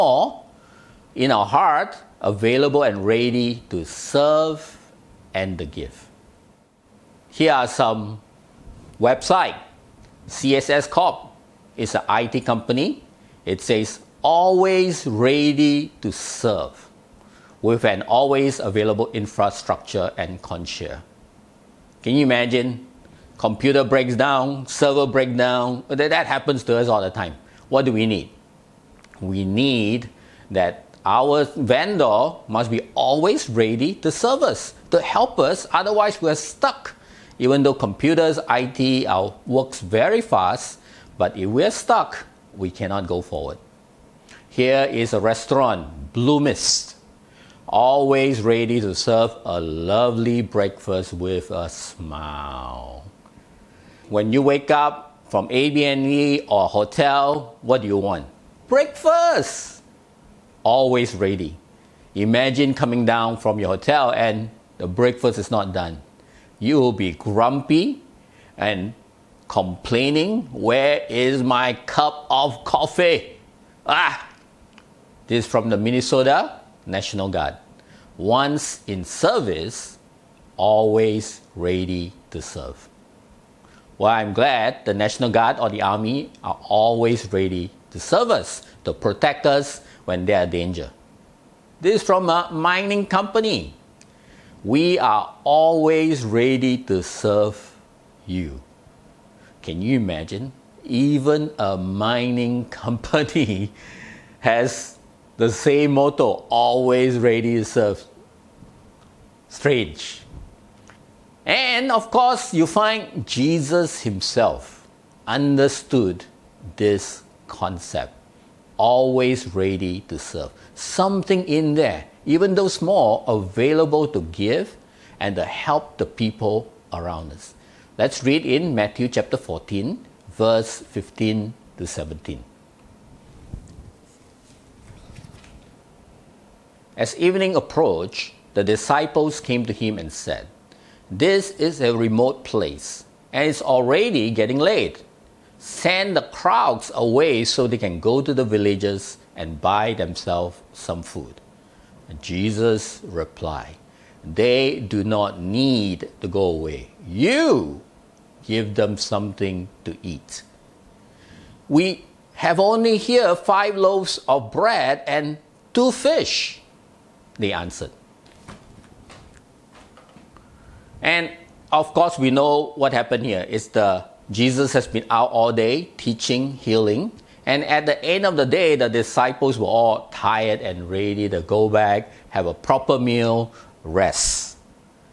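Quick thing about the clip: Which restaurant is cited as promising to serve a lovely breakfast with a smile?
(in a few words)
Blue Mist.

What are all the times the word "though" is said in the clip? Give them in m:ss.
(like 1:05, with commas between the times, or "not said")
0:37, 2:02.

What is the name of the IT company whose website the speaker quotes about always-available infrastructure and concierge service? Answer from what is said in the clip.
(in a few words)
CSS Corp.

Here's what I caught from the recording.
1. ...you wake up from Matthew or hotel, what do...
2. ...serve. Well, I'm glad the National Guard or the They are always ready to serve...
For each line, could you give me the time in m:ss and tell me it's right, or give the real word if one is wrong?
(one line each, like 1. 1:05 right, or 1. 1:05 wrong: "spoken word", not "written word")
1. 0:54 wrong: "Airbnb", not "Matthew"
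2. 1:22 wrong: "Army", not "They".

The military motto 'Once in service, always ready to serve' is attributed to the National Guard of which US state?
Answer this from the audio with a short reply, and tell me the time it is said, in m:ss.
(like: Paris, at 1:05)
Minnesota, at 1:15.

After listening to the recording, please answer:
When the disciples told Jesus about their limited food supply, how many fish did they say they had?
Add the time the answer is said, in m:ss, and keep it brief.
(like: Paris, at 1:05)
2, at 2:45.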